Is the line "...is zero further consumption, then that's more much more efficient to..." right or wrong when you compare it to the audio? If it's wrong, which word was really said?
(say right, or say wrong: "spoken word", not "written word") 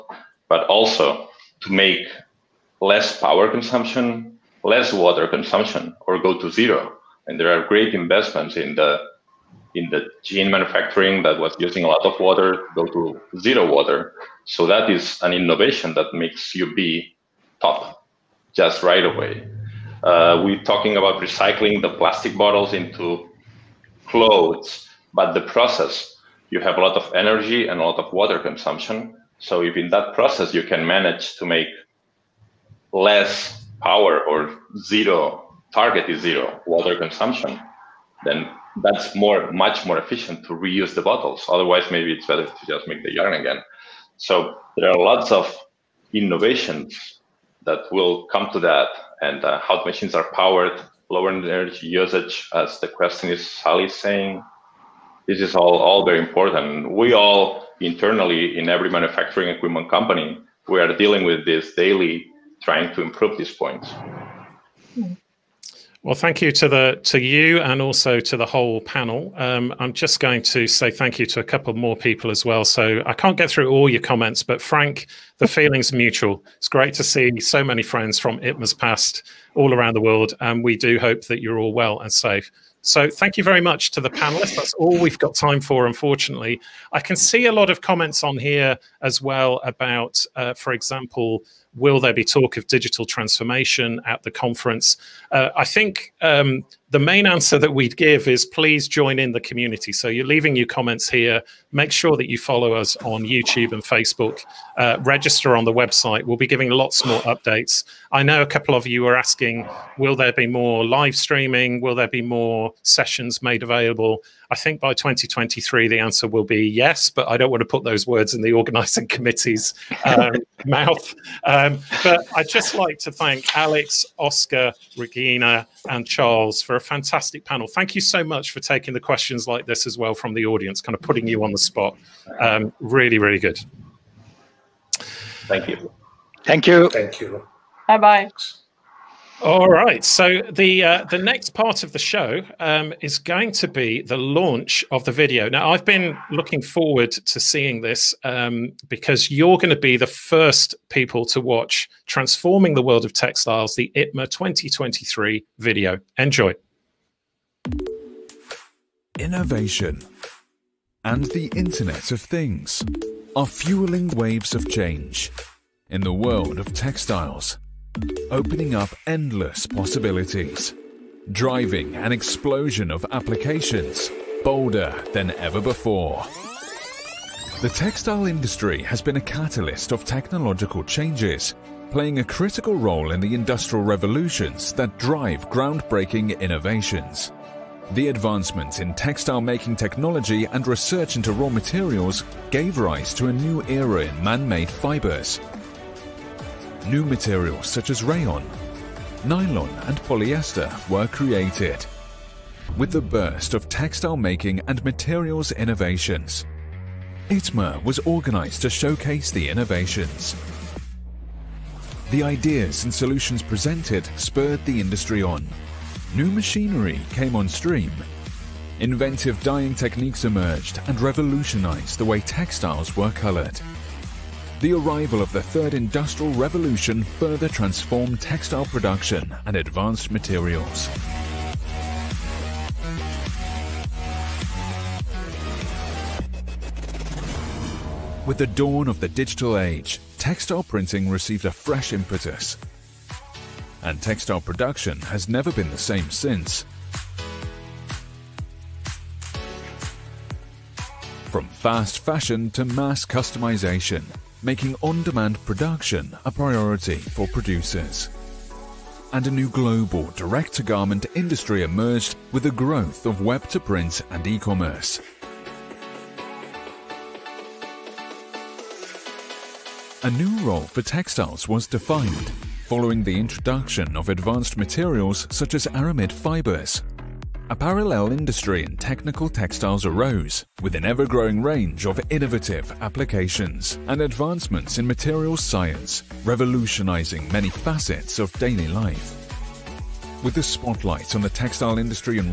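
wrong: "water", not "further".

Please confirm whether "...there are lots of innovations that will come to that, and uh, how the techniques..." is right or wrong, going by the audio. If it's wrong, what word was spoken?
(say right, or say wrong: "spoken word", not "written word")
wrong: "machines", not "techniques".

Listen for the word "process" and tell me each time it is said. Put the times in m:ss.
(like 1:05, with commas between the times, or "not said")
0:25, 0:30.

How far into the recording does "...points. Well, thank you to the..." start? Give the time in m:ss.
1:03.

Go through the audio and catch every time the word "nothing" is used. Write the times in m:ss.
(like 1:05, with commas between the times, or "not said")
not said.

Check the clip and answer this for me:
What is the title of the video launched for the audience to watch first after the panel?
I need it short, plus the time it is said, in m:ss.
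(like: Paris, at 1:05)
Transforming the World of Textiles, at 2:32.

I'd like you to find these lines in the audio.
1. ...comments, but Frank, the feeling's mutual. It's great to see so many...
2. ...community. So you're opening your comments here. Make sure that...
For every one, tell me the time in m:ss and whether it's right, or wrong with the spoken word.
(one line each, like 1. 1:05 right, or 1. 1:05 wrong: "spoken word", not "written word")
1. 1:14 right
2. 1:39 wrong: "leaving", not "opening".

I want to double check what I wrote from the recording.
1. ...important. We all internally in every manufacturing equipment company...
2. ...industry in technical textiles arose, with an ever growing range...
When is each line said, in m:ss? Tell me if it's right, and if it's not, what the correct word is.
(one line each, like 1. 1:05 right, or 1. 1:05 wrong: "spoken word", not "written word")
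1. 0:56 right
2. 4:38 right.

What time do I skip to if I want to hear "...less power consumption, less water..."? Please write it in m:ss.
0:02.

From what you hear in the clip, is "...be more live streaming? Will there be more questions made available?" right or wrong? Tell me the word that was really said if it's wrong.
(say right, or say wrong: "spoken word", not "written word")
wrong: "sessions", not "questions".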